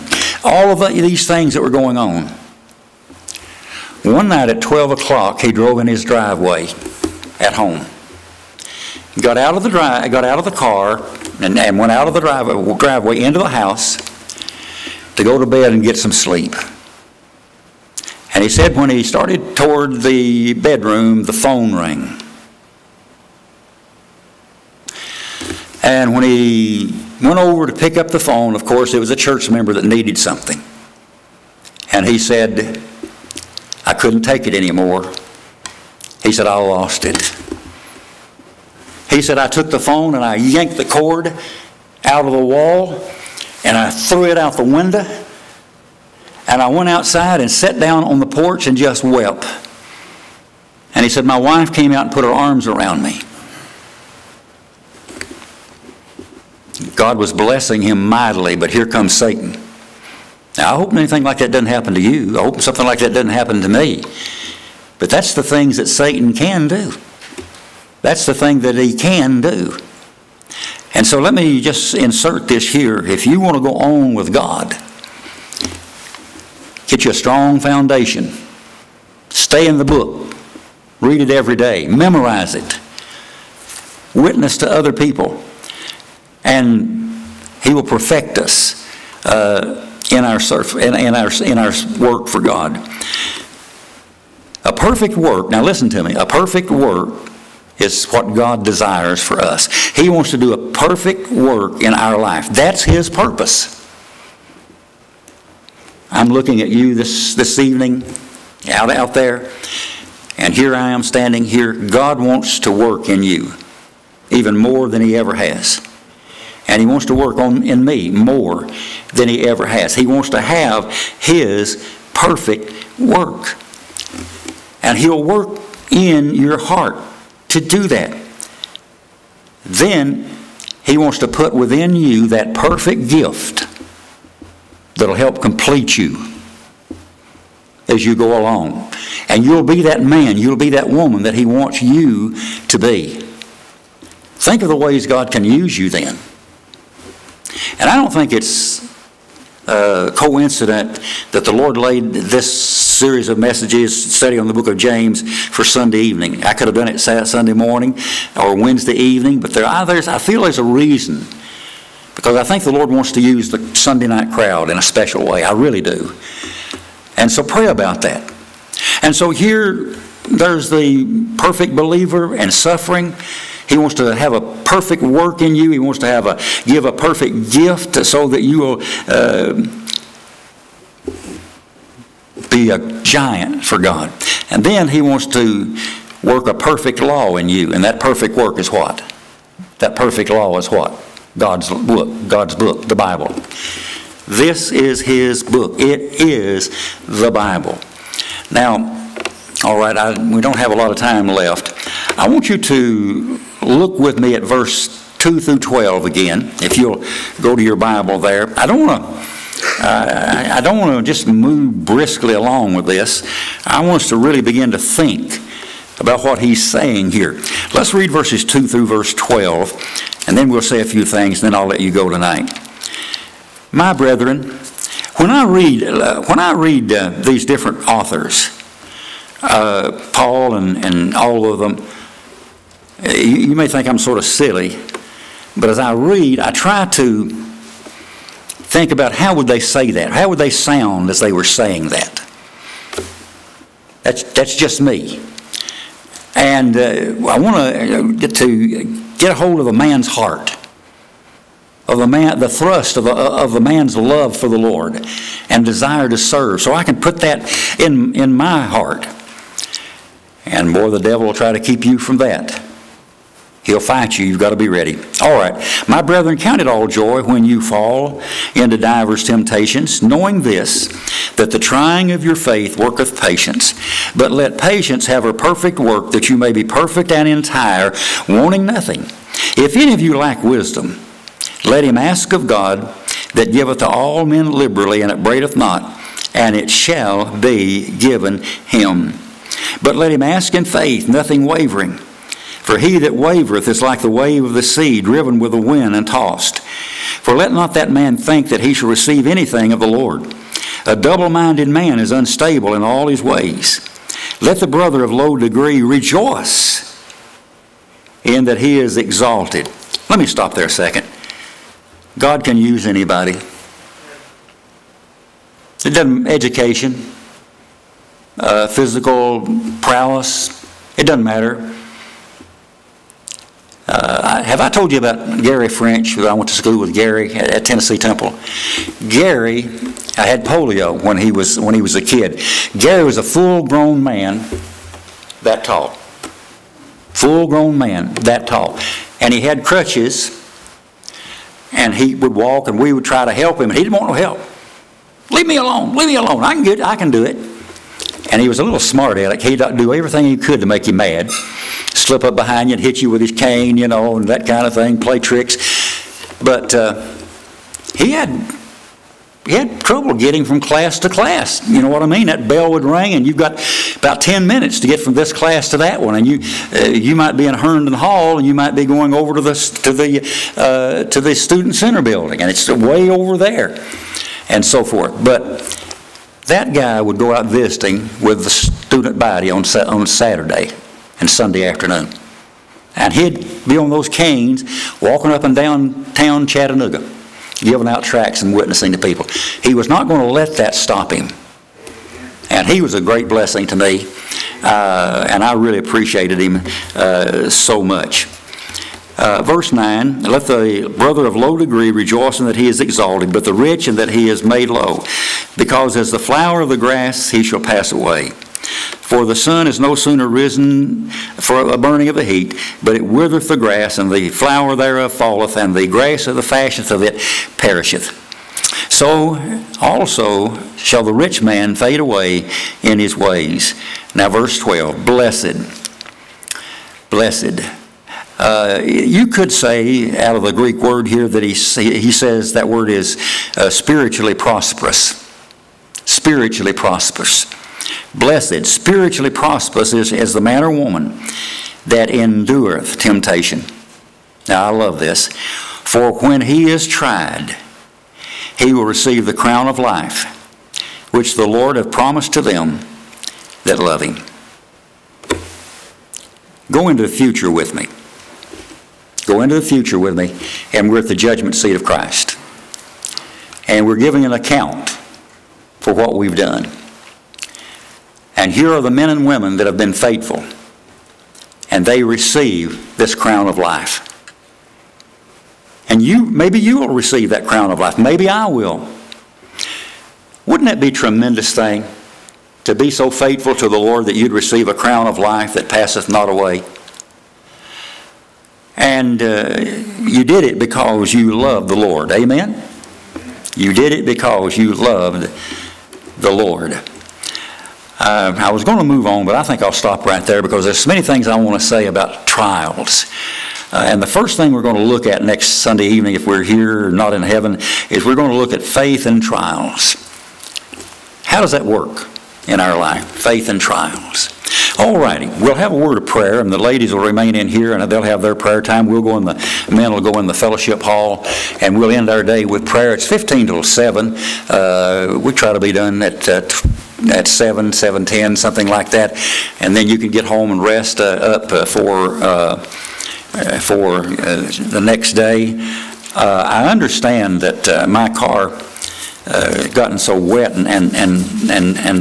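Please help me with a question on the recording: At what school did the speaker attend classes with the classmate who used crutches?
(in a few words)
Tennessee Temple.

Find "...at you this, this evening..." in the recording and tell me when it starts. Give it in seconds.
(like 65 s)
106 s.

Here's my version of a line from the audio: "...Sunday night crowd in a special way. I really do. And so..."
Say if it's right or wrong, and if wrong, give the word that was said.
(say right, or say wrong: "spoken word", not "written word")
right.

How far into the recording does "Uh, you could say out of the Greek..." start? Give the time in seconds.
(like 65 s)
428 s.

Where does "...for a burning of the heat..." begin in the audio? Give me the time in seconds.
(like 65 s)
411 s.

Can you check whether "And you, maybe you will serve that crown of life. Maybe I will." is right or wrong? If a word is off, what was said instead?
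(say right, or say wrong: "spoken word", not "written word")
wrong: "receive", not "serve".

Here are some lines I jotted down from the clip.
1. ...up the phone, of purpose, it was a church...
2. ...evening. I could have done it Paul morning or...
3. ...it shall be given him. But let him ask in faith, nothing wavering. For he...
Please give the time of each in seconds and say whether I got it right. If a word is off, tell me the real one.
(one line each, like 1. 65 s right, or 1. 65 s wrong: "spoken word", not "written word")
1. 27 s wrong: "course", not "purpose"
2. 155 s wrong: "Sunday", not "Paul"
3. 286 s right.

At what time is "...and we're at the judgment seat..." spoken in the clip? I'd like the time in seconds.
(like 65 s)
460 s.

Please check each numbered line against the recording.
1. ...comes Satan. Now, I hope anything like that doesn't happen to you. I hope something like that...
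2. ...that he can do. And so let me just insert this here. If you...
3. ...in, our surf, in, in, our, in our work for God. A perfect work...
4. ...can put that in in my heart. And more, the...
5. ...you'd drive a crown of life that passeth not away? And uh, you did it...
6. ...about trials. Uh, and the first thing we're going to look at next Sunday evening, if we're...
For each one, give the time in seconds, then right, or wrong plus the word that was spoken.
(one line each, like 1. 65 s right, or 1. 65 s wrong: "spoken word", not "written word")
1. 58 s right
2. 68 s right
3. 90 s right
4. 256 s right
5. 484 s wrong: "receive", not "drive"
6. 501 s right.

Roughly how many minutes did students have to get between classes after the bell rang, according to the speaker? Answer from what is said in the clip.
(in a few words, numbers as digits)
10.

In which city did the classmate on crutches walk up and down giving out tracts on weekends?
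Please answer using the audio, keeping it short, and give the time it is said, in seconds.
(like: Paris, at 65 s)
Chattanooga, at 386 s.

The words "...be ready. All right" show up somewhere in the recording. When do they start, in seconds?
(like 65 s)
264 s.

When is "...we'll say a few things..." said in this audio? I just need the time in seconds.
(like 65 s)
220 s.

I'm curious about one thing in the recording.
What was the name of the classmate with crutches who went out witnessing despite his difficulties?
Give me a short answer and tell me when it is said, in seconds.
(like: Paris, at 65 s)
Gary French, at 325 s.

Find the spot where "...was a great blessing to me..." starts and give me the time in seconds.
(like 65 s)
392 s.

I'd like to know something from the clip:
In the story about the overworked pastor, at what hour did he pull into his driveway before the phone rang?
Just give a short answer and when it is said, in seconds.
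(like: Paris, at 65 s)
12 o'clock, at 4 s.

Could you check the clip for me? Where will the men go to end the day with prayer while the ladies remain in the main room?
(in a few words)
fellowship hall.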